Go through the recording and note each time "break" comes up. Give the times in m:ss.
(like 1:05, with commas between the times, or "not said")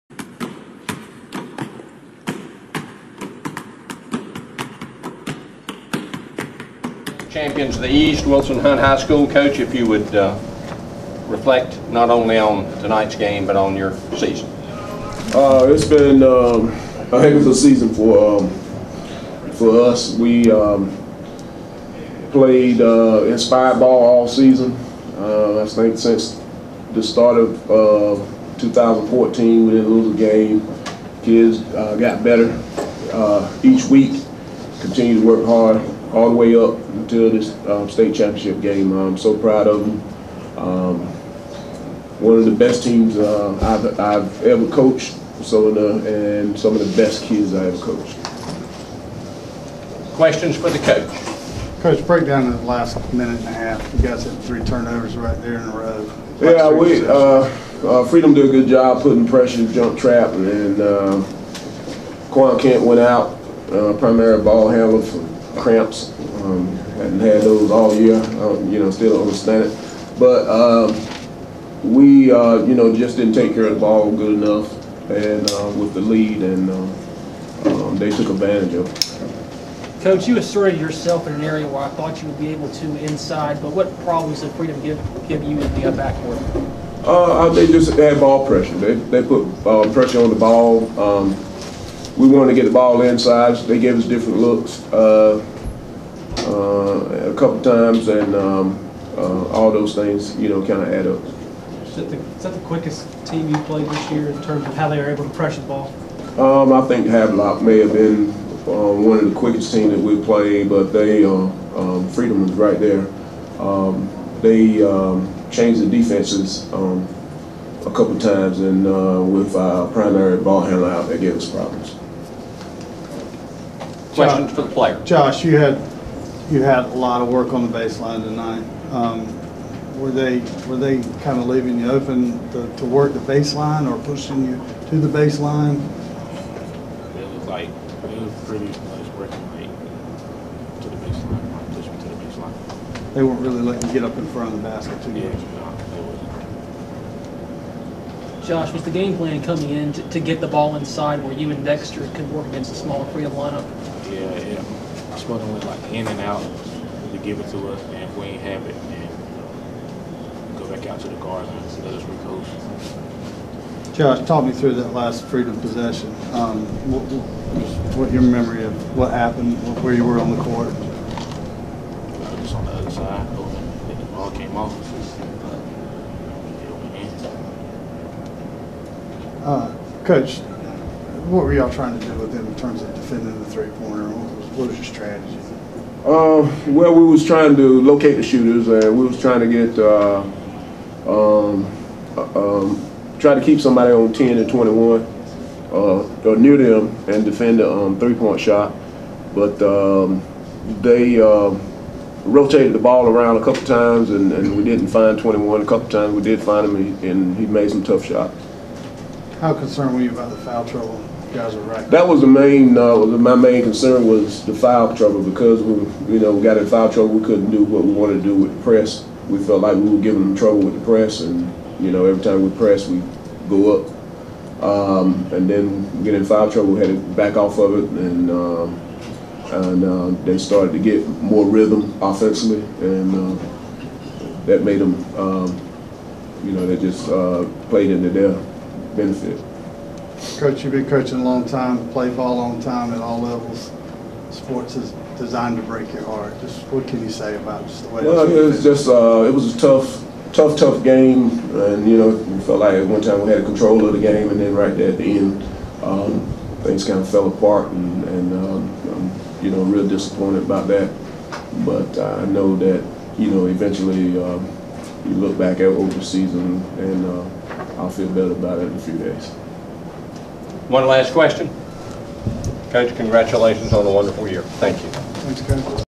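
0:52, 4:05.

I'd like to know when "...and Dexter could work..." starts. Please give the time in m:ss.
2:31.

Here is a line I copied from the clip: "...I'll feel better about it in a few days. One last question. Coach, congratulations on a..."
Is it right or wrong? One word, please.
right.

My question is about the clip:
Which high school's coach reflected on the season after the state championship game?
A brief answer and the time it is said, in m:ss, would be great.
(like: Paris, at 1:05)
Wilson Hunt High School, at 0:08.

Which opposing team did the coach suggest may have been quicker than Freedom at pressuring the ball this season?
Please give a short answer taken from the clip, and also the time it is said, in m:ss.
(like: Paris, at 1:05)
Havelock, at 1:47.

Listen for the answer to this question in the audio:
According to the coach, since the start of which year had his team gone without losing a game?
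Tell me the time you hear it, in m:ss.
0:28.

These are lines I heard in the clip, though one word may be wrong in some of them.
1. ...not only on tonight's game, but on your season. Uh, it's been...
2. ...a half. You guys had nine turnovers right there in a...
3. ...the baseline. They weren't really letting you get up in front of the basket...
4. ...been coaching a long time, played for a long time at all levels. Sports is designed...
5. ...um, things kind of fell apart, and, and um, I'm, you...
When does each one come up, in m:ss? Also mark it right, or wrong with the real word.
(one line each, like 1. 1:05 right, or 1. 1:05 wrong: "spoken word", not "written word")
1. 0:11 right
2. 0:53 wrong: "three", not "nine"
3. 2:22 right
4. 4:00 right
5. 4:15 right.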